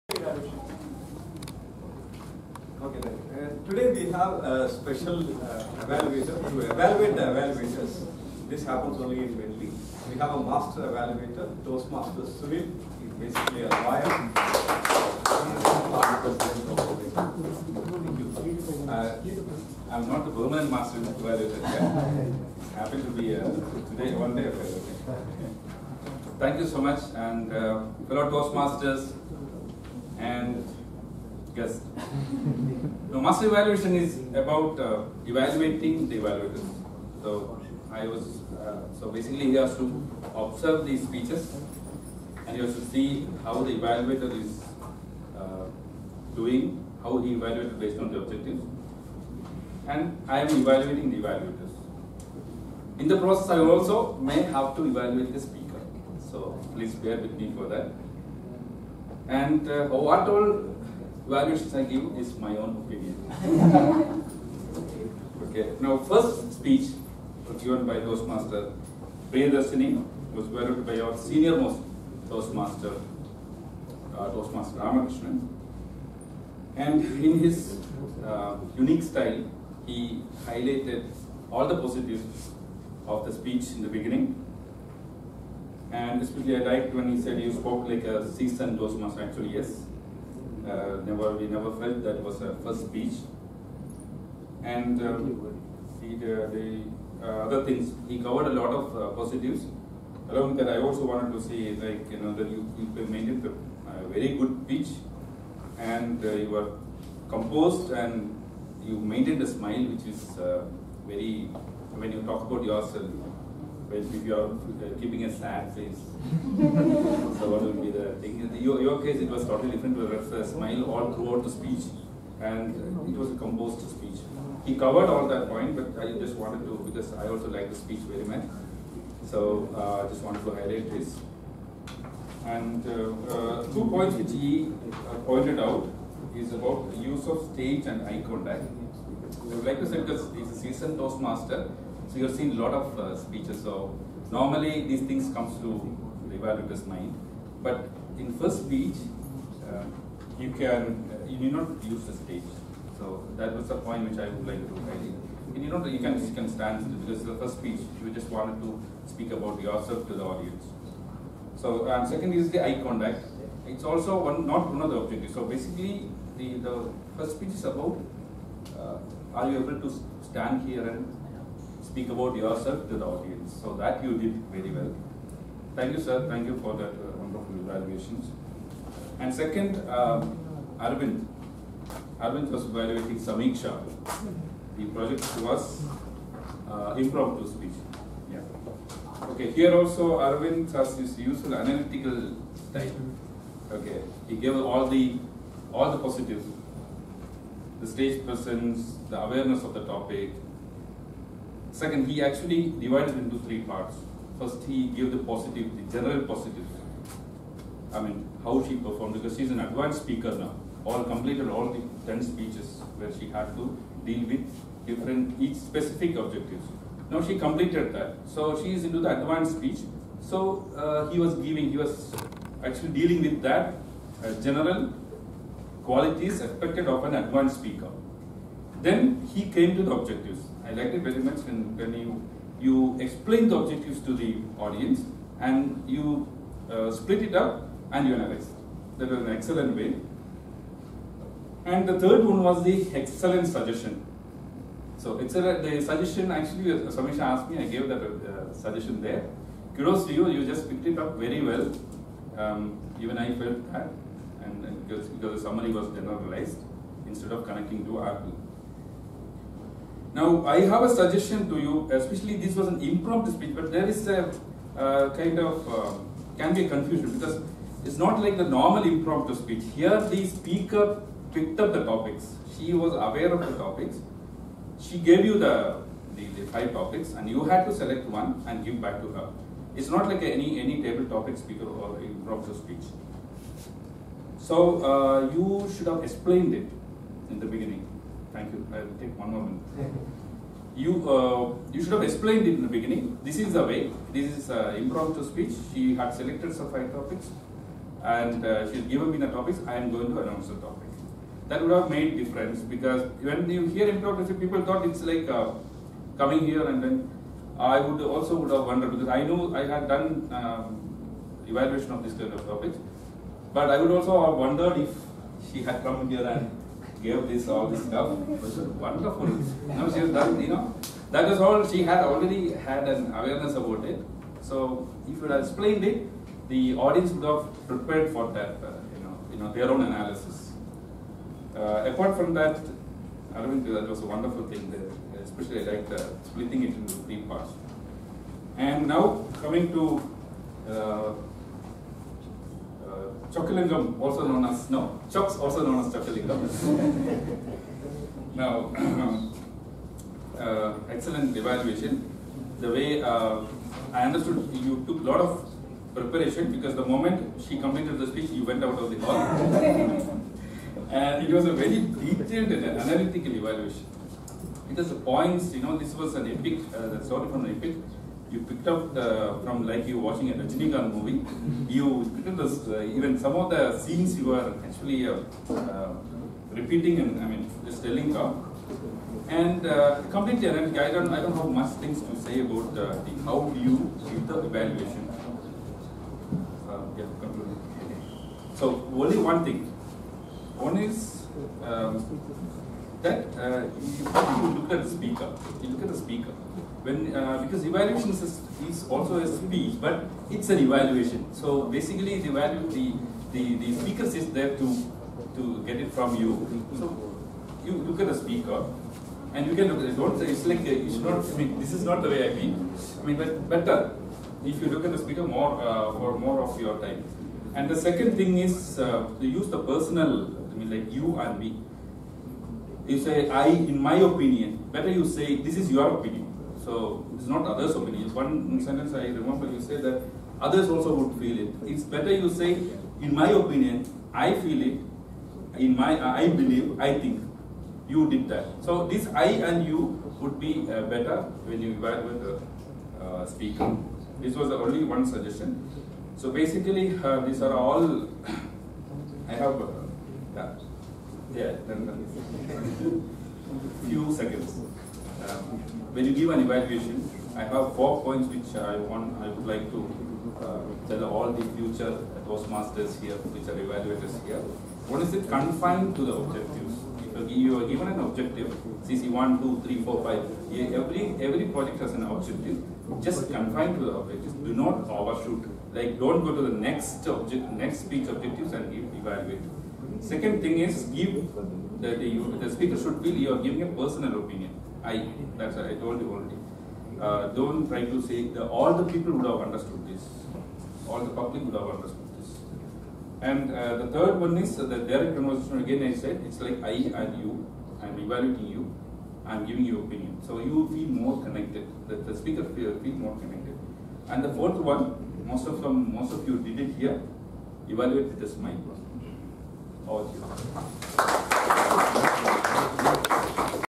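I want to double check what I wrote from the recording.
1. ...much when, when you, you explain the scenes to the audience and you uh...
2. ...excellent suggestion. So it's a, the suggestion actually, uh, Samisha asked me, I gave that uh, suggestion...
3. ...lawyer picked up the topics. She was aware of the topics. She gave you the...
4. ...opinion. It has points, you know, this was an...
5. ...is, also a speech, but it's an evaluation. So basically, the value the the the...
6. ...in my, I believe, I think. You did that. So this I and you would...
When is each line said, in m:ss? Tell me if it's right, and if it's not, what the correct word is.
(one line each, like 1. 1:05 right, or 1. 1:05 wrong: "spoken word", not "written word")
1. 3:51 wrong: "objectives", not "scenes"
2. 4:02 right
3. 4:30 wrong: "speaker", not "lawyer"
4. 6:03 wrong: "evaluation", not "opinion"
5. 6:38 right
6. 7:15 right.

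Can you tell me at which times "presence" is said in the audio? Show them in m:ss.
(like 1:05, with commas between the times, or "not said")
3:18.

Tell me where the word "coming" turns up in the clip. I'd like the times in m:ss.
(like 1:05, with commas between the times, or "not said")
5:06, 5:39.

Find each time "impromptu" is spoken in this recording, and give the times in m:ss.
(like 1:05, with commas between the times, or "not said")
3:07, 4:22, 4:28, 4:42, 4:54, 5:03.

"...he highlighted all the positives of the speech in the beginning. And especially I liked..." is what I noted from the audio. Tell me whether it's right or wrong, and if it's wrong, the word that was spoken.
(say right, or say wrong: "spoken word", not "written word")
right.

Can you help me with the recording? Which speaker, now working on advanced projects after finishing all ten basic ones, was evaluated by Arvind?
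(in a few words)
Samiksha.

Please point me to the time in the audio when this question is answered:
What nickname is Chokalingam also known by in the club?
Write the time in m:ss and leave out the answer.
5:45.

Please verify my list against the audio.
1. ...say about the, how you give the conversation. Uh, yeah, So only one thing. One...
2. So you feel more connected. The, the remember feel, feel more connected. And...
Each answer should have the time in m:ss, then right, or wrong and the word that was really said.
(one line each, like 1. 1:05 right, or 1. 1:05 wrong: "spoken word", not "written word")
1. 6:22 wrong: "evaluation", not "conversation"
2. 8:20 wrong: "speaker", not "remember".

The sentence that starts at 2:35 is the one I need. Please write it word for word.
And you know you can you can stand because the first speech you just wanted to speak about yourself to the audience.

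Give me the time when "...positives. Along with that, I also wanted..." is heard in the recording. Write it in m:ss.
1:39.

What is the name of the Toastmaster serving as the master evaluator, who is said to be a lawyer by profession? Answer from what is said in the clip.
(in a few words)
Sunil.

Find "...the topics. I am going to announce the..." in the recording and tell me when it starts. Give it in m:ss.
4:59.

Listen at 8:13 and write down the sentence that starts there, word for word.
And uh, the third one is uh, the direct conversation.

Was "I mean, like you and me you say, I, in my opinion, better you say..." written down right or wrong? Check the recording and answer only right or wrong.
right.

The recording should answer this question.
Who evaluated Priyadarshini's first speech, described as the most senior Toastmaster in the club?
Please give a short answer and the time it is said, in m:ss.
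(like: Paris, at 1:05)
Ramakrishnan, at 1:14.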